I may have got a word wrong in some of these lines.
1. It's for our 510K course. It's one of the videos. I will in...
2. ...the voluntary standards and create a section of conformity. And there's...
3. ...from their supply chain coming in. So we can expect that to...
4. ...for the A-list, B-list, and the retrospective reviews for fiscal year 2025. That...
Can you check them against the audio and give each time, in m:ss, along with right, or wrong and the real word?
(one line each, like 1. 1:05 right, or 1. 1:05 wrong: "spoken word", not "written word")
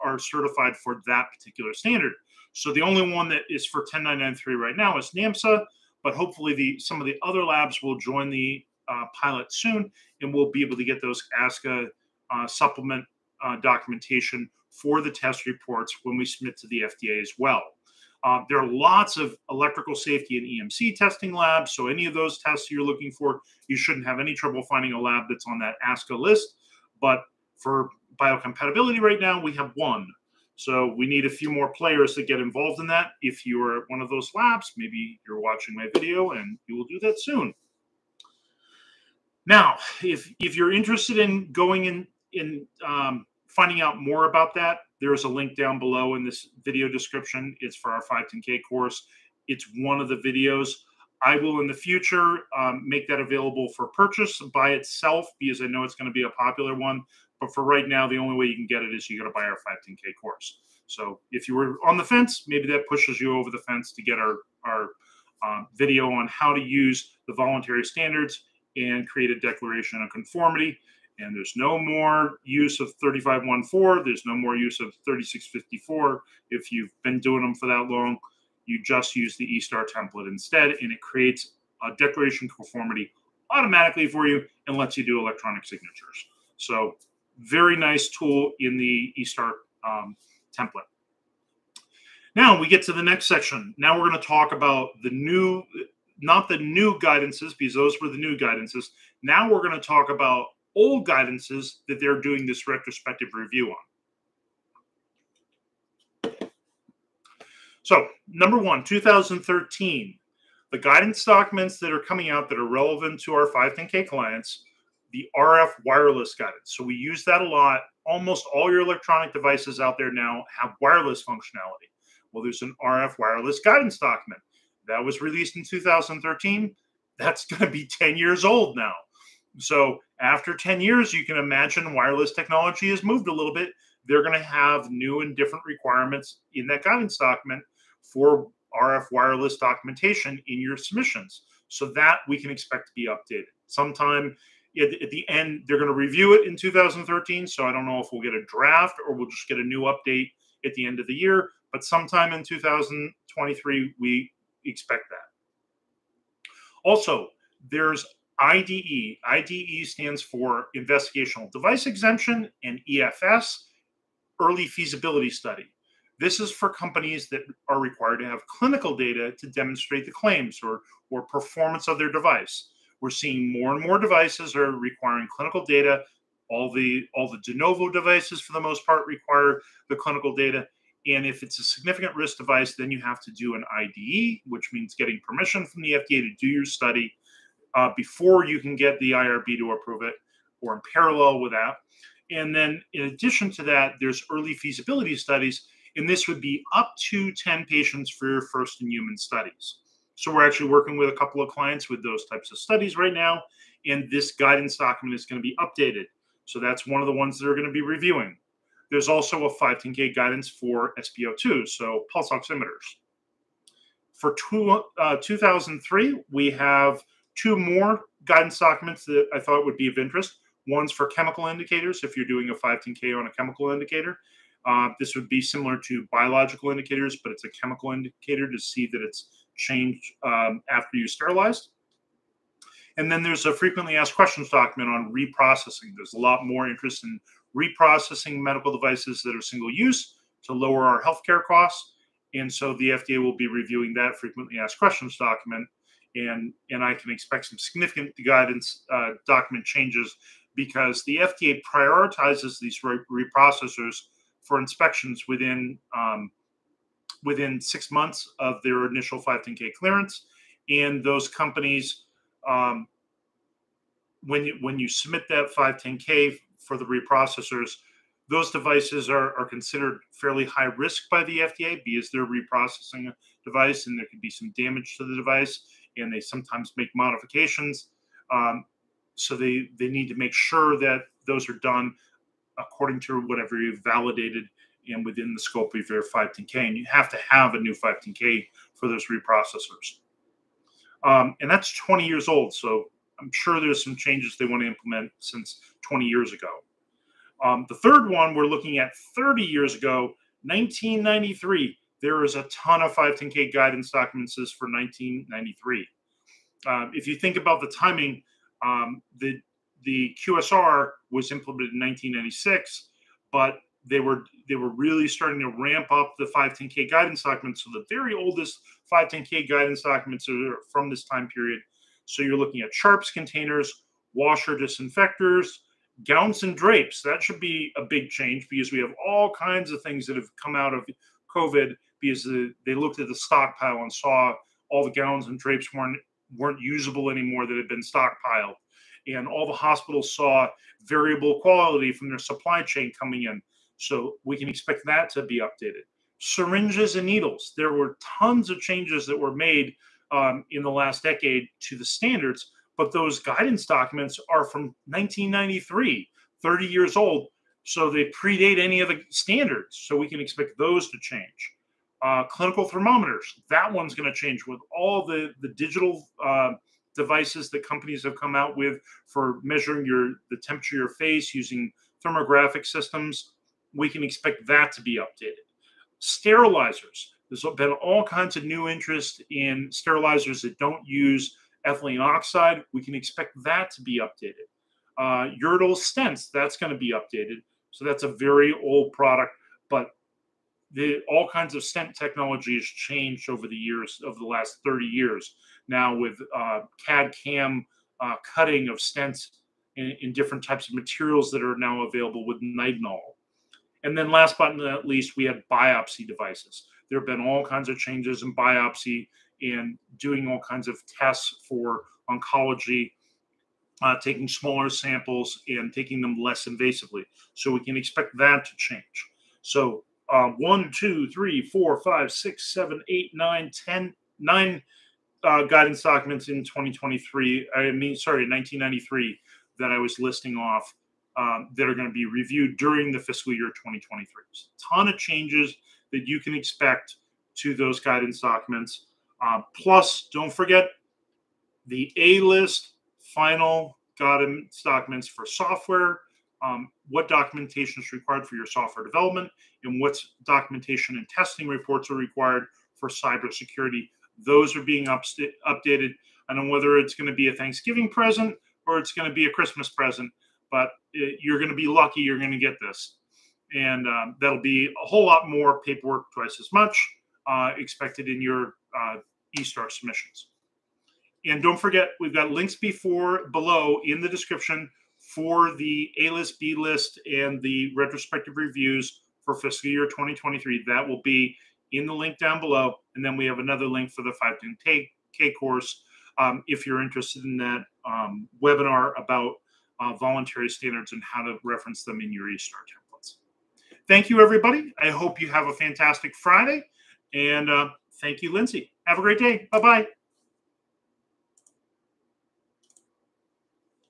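1. 0:47 right
2. 1:07 wrong: "declaration", not "section"
3. 5:41 right
4. 7:54 wrong: "2023", not "2025".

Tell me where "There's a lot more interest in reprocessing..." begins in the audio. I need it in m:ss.
3:55.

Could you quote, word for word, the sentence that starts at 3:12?
And then in addition to that, there's early feasibility studies.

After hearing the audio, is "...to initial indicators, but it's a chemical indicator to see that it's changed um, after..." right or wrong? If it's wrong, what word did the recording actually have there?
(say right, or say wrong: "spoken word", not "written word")
wrong: "biological", not "initial".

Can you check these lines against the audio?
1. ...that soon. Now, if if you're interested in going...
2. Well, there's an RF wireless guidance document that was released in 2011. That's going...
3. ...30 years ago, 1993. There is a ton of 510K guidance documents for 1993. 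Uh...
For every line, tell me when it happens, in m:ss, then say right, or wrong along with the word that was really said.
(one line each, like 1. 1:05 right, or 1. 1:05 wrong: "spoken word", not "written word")
1. 0:36 right
2. 2:02 wrong: "2013", not "2011"
3. 4:59 right.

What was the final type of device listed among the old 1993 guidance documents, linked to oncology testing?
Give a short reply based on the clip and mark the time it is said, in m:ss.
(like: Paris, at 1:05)
biopsy devices, at 6:45.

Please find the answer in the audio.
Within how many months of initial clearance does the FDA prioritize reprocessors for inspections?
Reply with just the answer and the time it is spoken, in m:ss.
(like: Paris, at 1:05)
6 months, at 4:17.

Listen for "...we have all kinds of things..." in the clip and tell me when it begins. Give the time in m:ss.
5:28.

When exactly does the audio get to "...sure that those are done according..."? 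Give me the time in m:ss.
4:40.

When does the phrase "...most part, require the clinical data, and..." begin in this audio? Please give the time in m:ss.
2:58.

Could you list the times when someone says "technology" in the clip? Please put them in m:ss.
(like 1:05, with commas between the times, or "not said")
2:12, 6:31.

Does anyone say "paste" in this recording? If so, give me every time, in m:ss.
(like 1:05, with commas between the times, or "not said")
not said.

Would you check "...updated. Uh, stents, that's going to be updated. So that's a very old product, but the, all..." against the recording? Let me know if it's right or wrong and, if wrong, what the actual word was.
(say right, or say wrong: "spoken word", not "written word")
right.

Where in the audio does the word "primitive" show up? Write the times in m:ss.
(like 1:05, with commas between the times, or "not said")
not said.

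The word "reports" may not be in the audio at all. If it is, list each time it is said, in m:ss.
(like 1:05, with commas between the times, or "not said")
0:15, 7:31.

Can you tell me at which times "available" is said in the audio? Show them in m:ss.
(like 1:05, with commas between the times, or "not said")
0:53, 6:41.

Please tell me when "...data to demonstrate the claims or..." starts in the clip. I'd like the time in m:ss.
2:48.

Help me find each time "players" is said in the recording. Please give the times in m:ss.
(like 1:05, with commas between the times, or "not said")
0:31.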